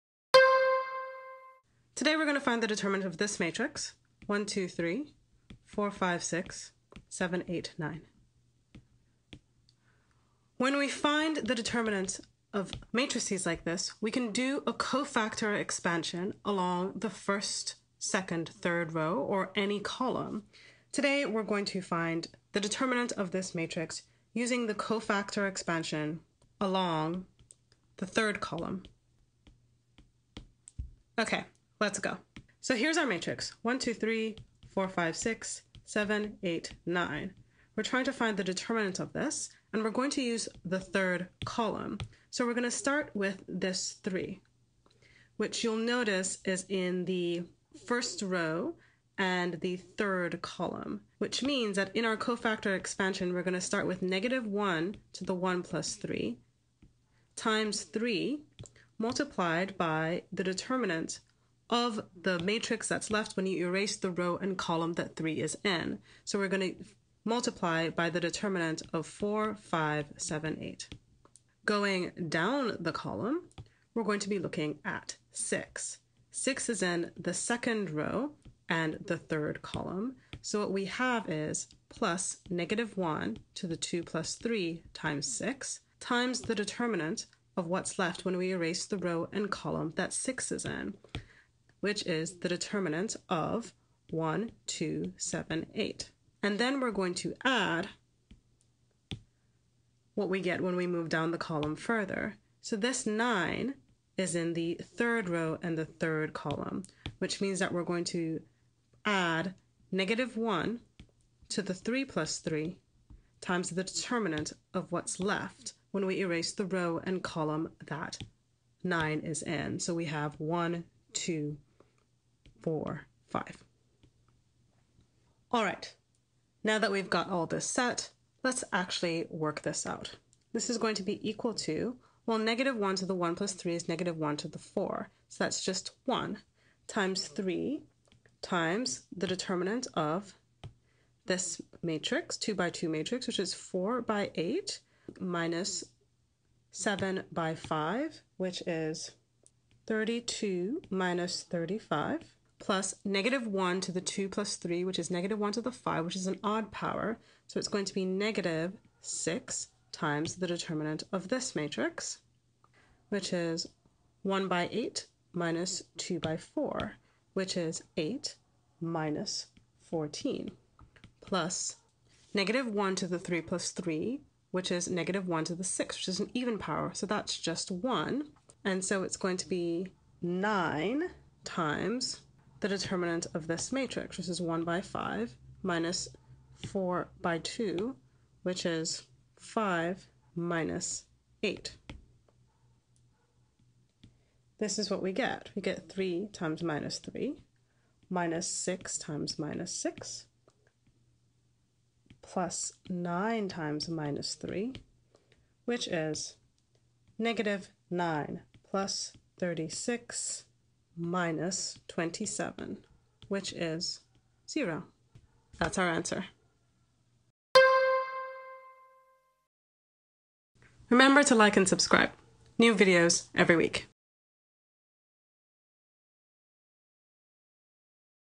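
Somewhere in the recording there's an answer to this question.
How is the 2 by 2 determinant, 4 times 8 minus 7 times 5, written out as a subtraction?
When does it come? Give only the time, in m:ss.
2:29.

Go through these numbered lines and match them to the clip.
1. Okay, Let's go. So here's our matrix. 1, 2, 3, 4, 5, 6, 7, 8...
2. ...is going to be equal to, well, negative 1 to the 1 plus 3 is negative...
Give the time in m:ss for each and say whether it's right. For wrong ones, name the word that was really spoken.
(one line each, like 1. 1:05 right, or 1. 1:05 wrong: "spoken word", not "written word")
1. 0:31 right
2. 2:10 right.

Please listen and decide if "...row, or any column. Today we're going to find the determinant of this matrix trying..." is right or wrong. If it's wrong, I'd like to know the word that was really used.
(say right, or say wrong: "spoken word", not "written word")
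wrong: "using", not "trying".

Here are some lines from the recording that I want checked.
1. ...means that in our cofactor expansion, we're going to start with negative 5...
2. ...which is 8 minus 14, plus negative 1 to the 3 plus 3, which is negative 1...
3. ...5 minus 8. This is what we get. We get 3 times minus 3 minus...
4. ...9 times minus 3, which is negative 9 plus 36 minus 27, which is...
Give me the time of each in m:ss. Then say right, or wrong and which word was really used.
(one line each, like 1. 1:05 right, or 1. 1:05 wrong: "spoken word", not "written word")
1. 0:51 wrong: "1", not "5"
2. 2:47 right
3. 3:09 right
4. 3:22 right.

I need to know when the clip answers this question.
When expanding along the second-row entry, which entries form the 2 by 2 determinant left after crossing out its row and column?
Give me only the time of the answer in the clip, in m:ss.
1:34.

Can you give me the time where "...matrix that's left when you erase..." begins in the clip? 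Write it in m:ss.
1:02.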